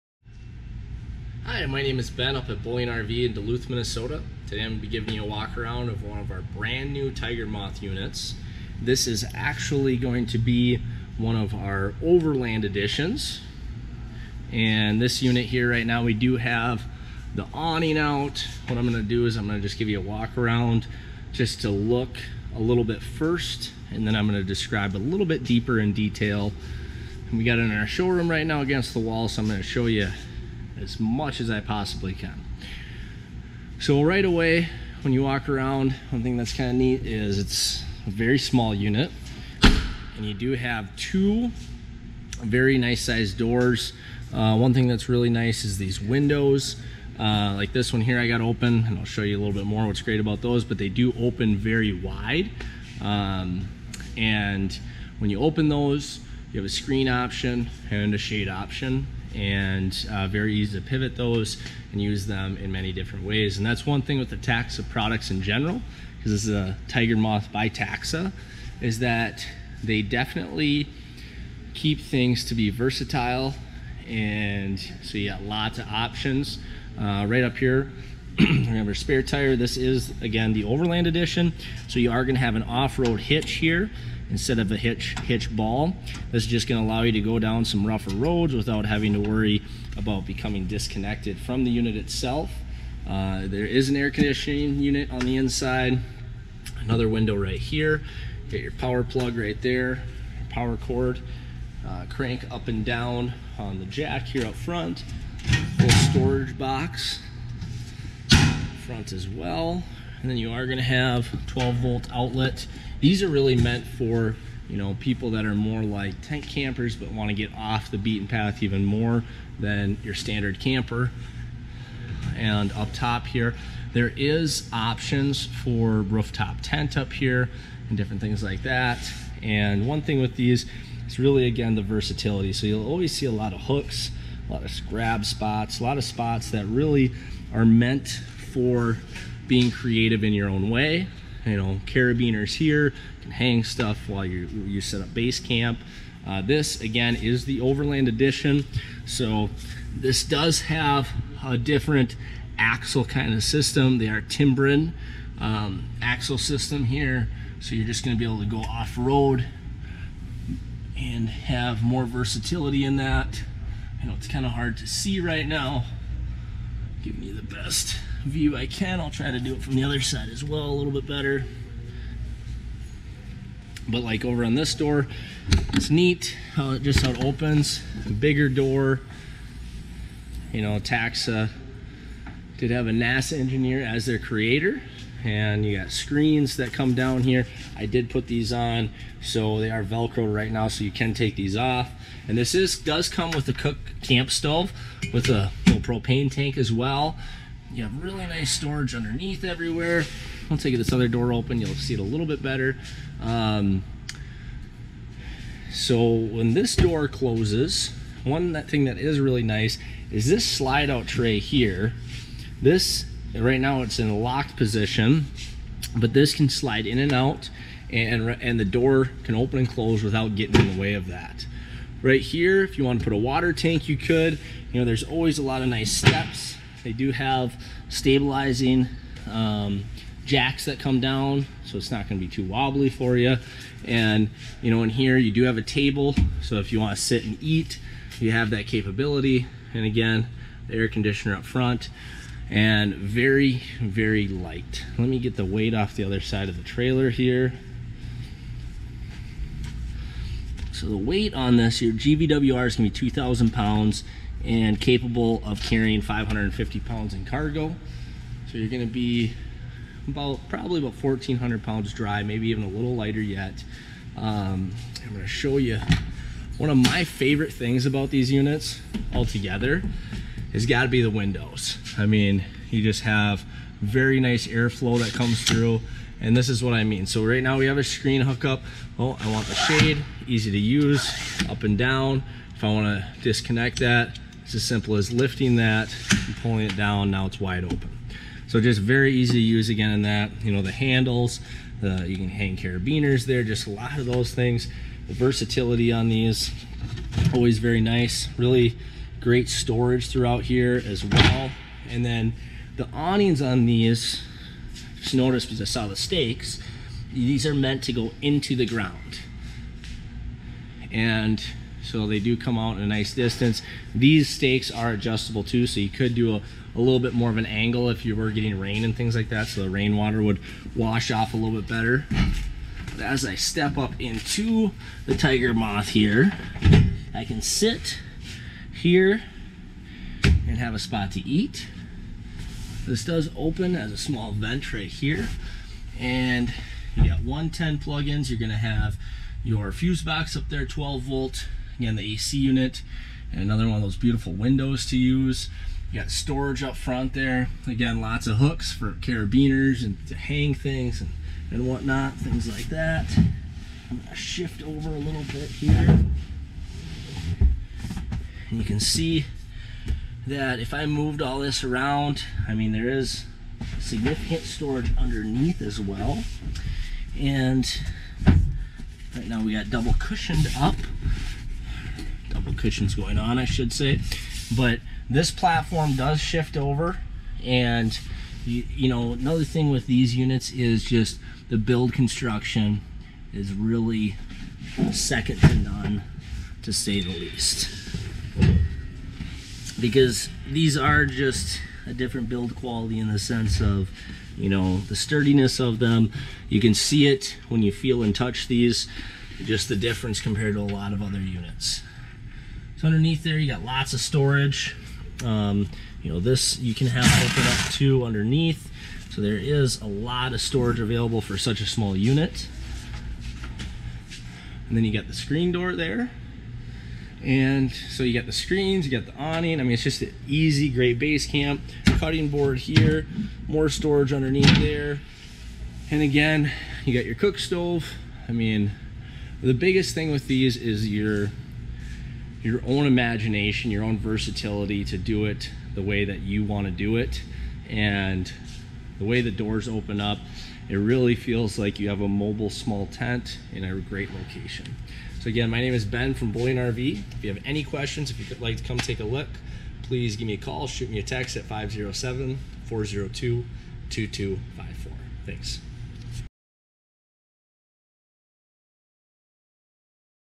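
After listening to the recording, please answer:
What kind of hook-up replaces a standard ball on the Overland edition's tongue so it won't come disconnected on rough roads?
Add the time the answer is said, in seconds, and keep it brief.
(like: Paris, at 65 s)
off-road hitch, at 82 s.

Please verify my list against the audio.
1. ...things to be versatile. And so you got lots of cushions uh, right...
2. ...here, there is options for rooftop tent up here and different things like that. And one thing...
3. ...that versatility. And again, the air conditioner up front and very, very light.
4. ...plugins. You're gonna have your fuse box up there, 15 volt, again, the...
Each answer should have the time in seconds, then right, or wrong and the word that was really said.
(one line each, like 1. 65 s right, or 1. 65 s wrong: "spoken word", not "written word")
1. 72 s wrong: "options", not "cushions"
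2. 123 s right
3. 238 s wrong: "capability", not "versatility"
4. 337 s wrong: "12", not "15".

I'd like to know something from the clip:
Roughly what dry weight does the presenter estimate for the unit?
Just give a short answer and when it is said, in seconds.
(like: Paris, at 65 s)
1400 pounds, at 261 s.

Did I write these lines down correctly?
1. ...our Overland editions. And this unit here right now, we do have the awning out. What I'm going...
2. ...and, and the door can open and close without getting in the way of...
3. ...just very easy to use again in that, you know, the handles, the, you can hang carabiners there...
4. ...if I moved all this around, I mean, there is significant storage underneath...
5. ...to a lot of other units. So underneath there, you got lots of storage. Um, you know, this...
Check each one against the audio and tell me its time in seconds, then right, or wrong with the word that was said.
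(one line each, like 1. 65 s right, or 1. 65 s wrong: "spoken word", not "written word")
1. 11 s right
2. 217 s right
3. 288 s right
4. 360 s right
5. 400 s right.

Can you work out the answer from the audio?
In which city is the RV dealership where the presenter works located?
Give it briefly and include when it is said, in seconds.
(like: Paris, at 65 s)
Duluth, Minnesota, at 3 s.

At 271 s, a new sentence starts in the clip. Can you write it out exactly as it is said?
I mean, you just have very nice airflow that comes through and this is what I mean.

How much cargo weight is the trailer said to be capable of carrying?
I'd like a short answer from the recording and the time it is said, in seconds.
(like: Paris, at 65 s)
550 pounds, at 256 s.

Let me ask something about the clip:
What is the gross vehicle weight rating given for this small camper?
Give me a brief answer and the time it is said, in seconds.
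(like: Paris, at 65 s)
2,000 pounds, at 252 s.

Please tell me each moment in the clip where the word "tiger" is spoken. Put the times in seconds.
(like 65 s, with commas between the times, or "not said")
7 s, 66 s, 325 s.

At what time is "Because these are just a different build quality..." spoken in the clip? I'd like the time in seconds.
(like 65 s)
389 s.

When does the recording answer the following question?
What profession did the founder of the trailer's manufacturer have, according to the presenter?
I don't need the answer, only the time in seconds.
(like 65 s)
182 s.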